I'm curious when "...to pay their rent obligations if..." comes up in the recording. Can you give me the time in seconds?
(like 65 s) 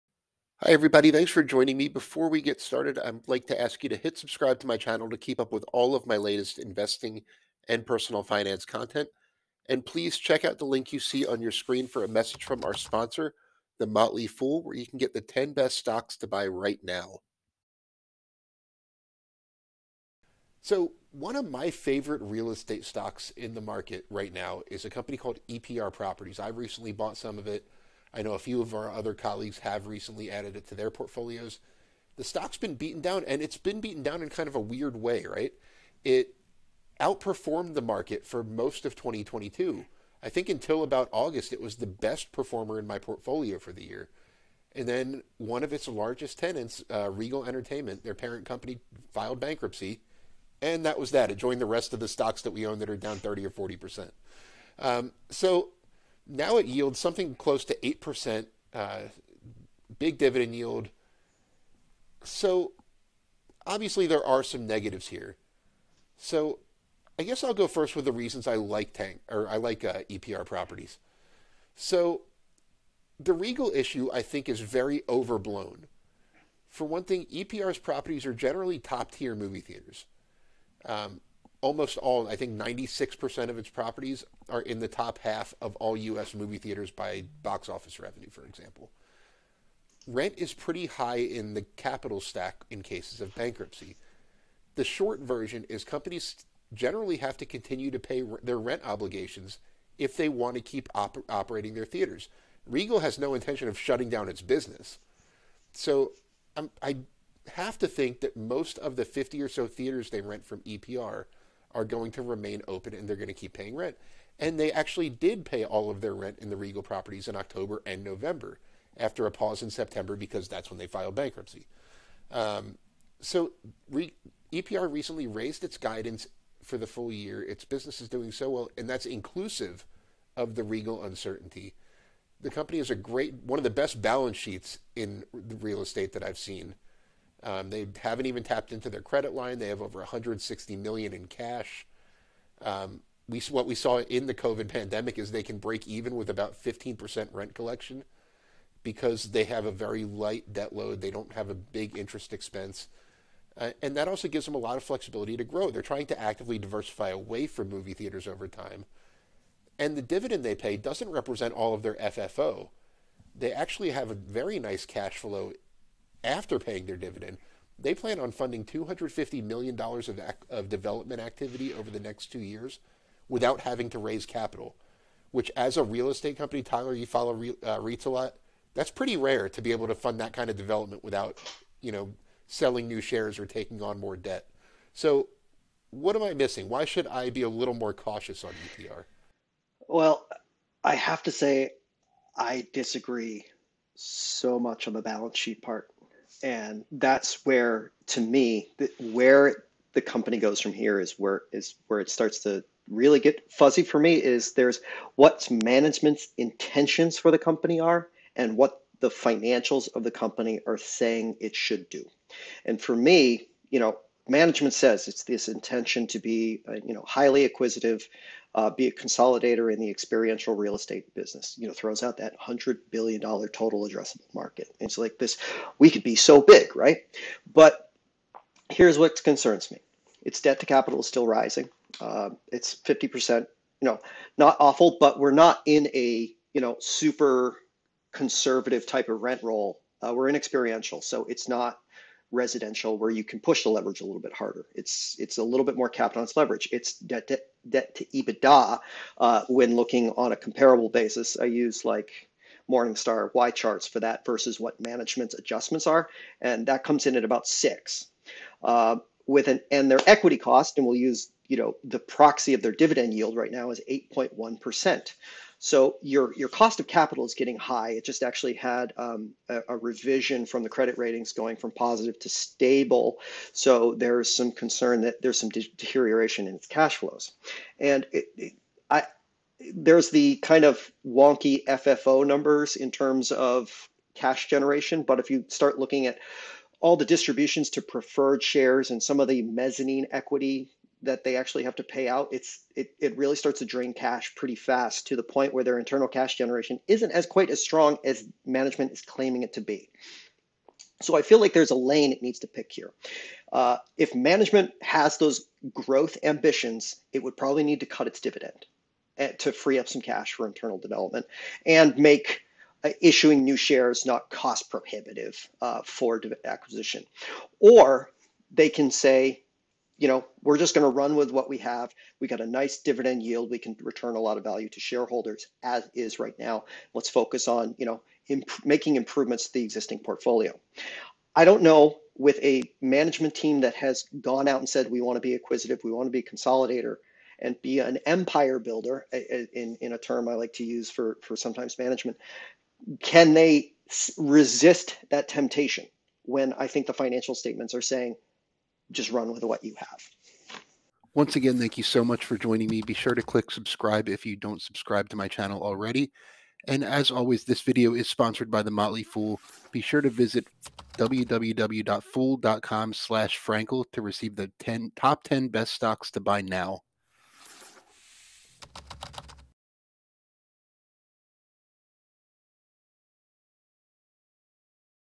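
97 s.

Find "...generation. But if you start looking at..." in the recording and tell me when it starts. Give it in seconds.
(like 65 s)
284 s.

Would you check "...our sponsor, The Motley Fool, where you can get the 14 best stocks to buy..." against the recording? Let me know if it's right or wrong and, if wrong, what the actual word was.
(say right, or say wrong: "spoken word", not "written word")
wrong: "10", not "14".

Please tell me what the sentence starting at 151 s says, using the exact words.
They don't have a big interest expense.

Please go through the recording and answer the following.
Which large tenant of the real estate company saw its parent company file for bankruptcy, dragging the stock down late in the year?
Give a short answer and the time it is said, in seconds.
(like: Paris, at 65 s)
Regal Entertainment, at 47 s.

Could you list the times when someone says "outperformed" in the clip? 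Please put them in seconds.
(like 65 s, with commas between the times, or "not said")
36 s.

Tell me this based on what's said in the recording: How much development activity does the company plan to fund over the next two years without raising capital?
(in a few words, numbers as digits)
$250 million.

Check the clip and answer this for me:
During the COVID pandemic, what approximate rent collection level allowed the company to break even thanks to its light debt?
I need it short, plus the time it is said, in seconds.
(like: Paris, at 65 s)
15%, at 146 s.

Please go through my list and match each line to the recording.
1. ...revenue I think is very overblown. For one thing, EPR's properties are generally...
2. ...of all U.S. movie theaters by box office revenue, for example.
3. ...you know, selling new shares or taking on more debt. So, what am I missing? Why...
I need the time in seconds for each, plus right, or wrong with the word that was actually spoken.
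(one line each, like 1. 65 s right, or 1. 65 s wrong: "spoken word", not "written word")
1. 73 s wrong: "issue", not "revenue"
2. 85 s right
3. 181 s right.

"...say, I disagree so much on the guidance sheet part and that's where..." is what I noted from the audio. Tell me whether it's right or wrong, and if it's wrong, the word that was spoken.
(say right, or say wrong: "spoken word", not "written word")
wrong: "balance", not "guidance".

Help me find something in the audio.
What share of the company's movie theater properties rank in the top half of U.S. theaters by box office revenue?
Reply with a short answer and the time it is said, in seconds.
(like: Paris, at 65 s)
96%, at 82 s.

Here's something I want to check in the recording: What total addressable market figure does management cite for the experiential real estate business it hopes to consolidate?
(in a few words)
100 billion dollars.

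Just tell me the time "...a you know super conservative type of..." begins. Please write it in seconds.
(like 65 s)
235 s.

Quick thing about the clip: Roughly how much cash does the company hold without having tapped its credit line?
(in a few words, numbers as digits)
Over 160 million.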